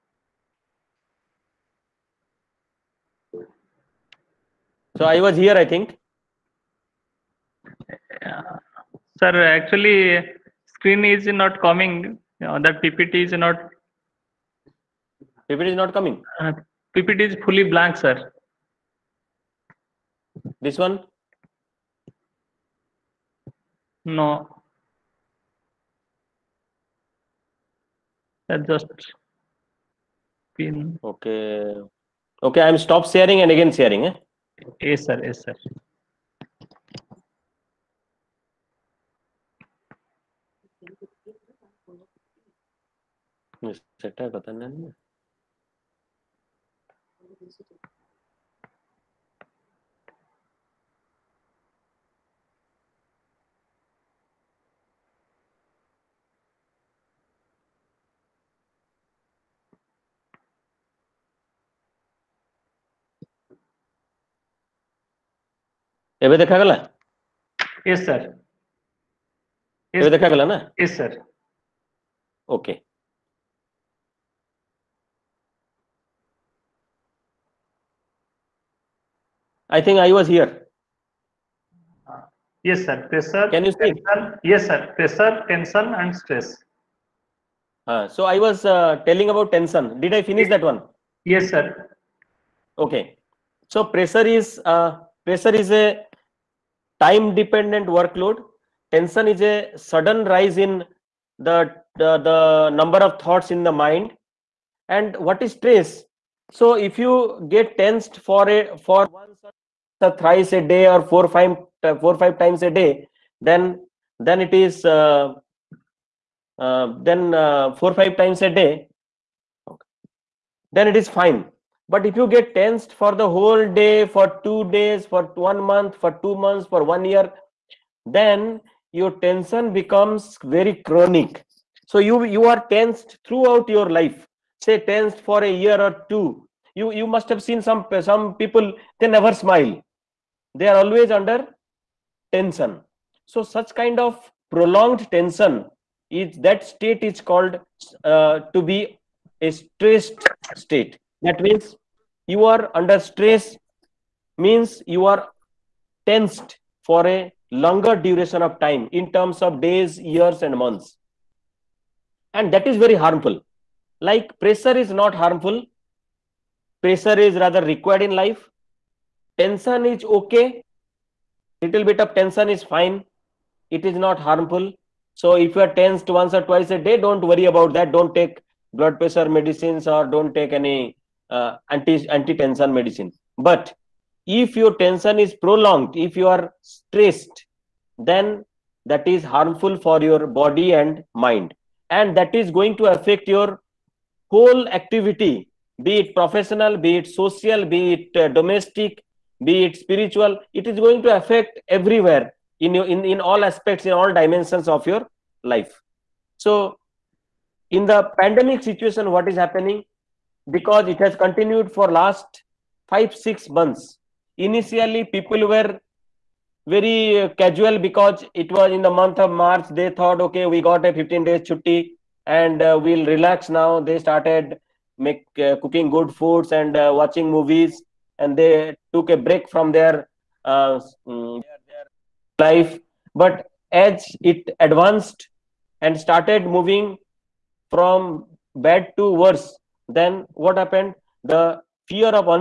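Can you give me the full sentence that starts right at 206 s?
So in the pandemic situation, what is happening?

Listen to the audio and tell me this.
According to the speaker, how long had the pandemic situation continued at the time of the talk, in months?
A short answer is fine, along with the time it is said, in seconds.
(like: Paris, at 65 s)
5 6 months, at 212 s.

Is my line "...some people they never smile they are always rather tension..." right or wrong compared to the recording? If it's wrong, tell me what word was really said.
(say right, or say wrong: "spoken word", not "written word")
wrong: "under", not "rather".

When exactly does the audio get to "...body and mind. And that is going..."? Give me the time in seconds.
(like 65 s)
190 s.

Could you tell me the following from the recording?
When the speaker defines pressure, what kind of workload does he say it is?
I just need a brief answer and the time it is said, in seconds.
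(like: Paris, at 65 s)
time dependent, at 97 s.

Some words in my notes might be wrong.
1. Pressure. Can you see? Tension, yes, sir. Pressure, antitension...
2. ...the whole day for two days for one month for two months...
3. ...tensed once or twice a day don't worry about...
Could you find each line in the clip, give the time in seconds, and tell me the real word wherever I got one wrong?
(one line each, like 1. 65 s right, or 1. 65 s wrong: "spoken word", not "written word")
1. 83 s wrong: "tension", not "antitension"
2. 123 s right
3. 175 s right.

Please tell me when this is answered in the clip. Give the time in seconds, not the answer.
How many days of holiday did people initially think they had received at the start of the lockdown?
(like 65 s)
220 s.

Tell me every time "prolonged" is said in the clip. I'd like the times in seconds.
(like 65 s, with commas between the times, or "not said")
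144 s, 185 s.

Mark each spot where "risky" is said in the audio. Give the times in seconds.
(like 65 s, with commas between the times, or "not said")
not said.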